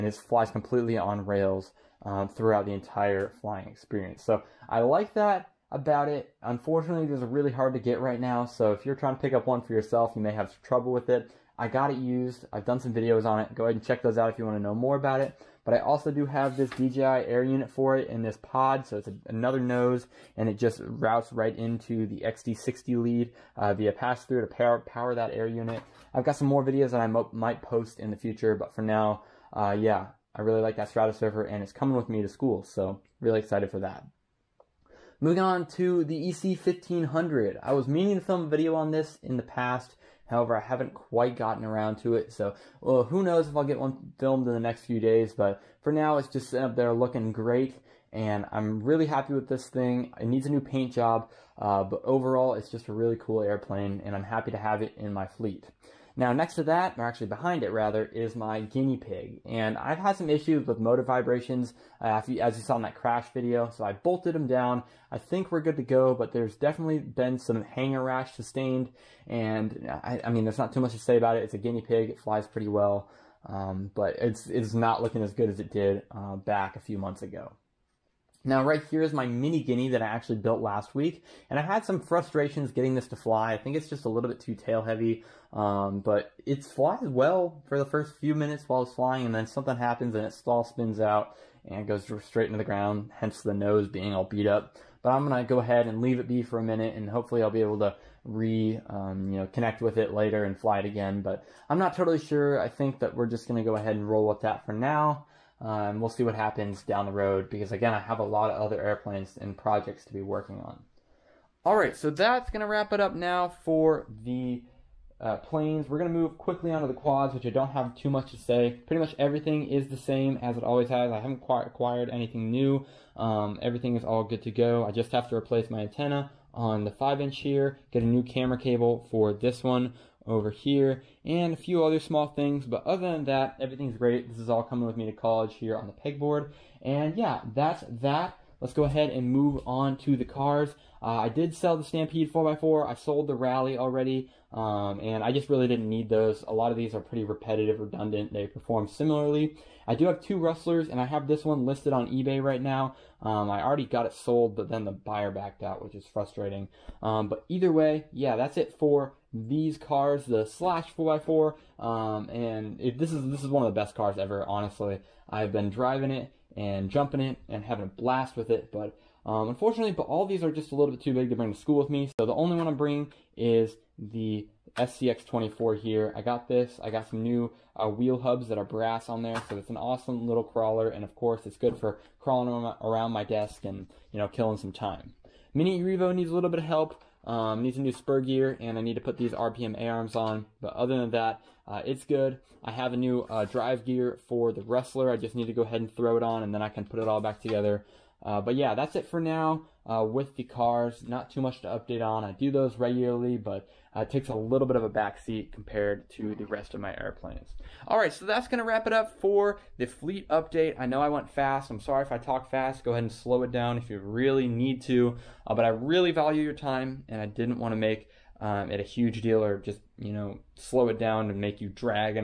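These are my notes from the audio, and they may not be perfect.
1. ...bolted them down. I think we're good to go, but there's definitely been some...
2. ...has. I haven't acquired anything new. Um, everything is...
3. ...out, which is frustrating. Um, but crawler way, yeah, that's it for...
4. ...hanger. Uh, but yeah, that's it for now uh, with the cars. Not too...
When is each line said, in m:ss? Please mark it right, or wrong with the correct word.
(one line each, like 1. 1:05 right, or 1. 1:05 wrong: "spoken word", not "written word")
1. 1:03 right
2. 2:00 right
3. 2:35 wrong: "either", not "crawler"
4. 3:17 wrong: "together", not "hanger".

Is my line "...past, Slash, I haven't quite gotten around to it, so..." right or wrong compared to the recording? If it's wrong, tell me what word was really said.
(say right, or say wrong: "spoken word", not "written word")
wrong: "However", not "Slash".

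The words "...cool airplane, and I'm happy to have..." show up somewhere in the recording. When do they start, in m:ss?
0:53.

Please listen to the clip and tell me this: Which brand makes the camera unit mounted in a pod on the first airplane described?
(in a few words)
DJI.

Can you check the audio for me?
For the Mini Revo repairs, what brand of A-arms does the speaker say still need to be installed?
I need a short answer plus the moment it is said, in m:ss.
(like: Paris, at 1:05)
RPM, at 3:09.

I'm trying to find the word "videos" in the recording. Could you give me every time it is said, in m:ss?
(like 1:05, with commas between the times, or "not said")
0:12, 0:26, 0:38, 1:03.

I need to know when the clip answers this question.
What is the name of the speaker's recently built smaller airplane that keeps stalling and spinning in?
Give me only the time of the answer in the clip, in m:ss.
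1:19.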